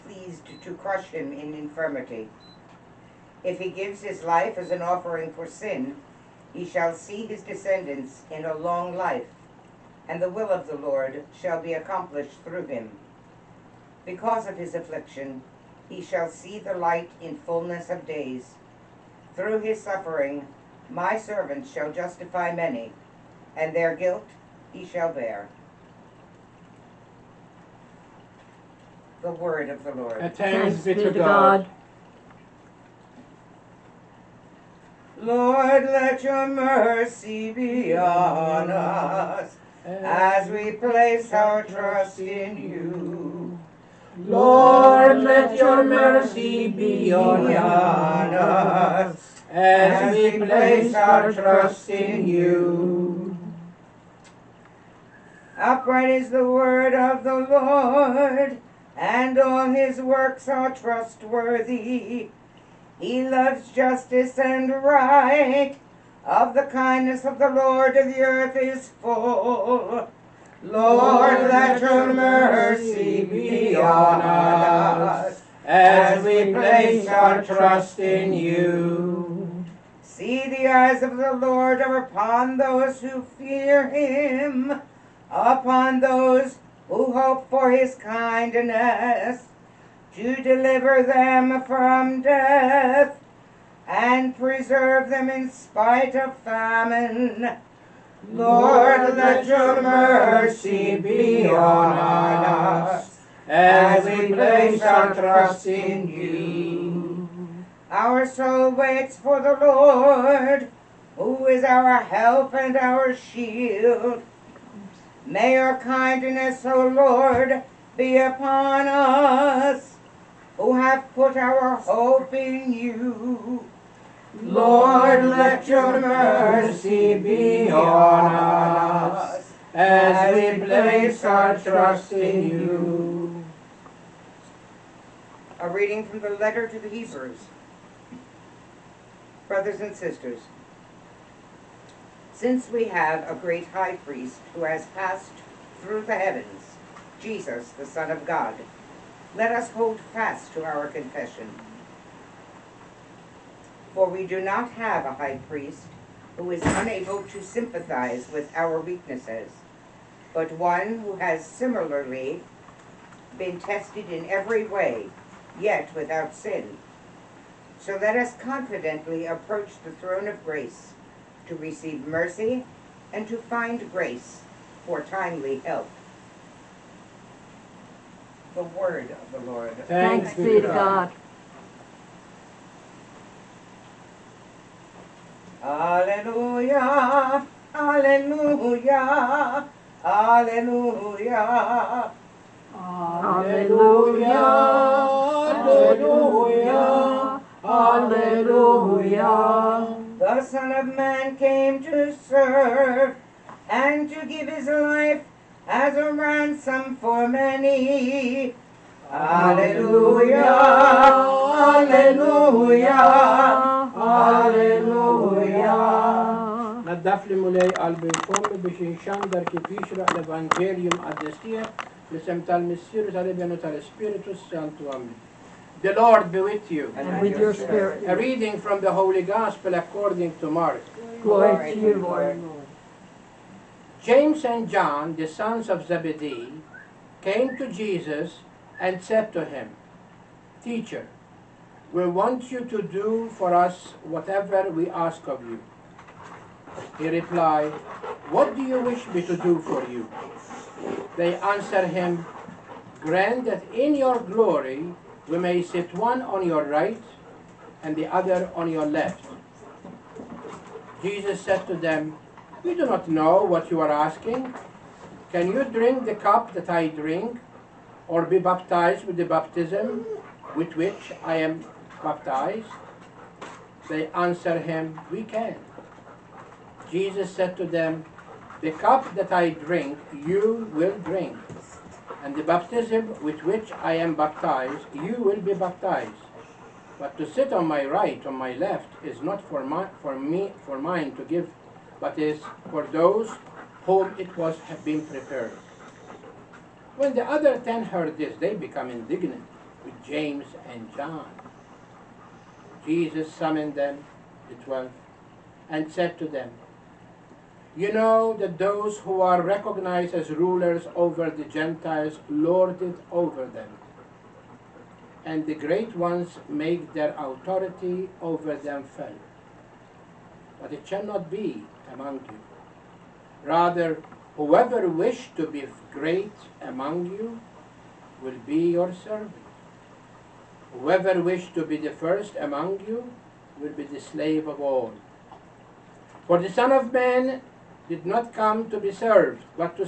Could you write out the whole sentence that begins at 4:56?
When the other ten heard this, they become indignant with James and John.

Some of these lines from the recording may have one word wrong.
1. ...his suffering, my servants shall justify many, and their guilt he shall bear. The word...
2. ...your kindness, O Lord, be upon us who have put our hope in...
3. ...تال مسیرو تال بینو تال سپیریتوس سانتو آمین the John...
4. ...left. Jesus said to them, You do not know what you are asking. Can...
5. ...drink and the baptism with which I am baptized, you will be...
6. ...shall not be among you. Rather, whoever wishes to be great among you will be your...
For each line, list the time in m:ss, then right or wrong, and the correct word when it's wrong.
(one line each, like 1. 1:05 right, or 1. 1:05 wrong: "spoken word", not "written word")
1. 0:19 right
2. 1:55 right
3. 3:42 wrong: "Lord", not "John"
4. 4:18 right
5. 4:40 right
6. 5:20 right.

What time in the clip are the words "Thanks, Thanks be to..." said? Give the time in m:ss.
2:59.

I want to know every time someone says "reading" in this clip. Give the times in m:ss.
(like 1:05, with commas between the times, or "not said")
2:15, 3:48.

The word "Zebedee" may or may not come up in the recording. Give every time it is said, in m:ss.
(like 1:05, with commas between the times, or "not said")
3:55.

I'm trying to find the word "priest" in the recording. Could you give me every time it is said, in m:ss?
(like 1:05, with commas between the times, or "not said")
2:23, 2:35.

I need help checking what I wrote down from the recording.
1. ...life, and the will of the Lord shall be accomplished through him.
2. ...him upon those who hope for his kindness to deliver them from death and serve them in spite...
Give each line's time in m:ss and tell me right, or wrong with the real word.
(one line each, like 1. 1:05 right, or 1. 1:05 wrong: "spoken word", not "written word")
1. 0:08 right
2. 1:23 wrong: "preserve", not "serve".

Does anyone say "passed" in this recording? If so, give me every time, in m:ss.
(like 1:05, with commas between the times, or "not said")
2:24.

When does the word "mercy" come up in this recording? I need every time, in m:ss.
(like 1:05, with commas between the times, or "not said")
0:36, 0:45, 1:12, 1:39, 2:05, 2:52.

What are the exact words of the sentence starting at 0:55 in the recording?
Upright is the word of the Lord, and all his works are trustworthy.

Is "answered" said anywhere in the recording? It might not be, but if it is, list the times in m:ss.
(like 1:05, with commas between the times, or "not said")
4:11, 4:34.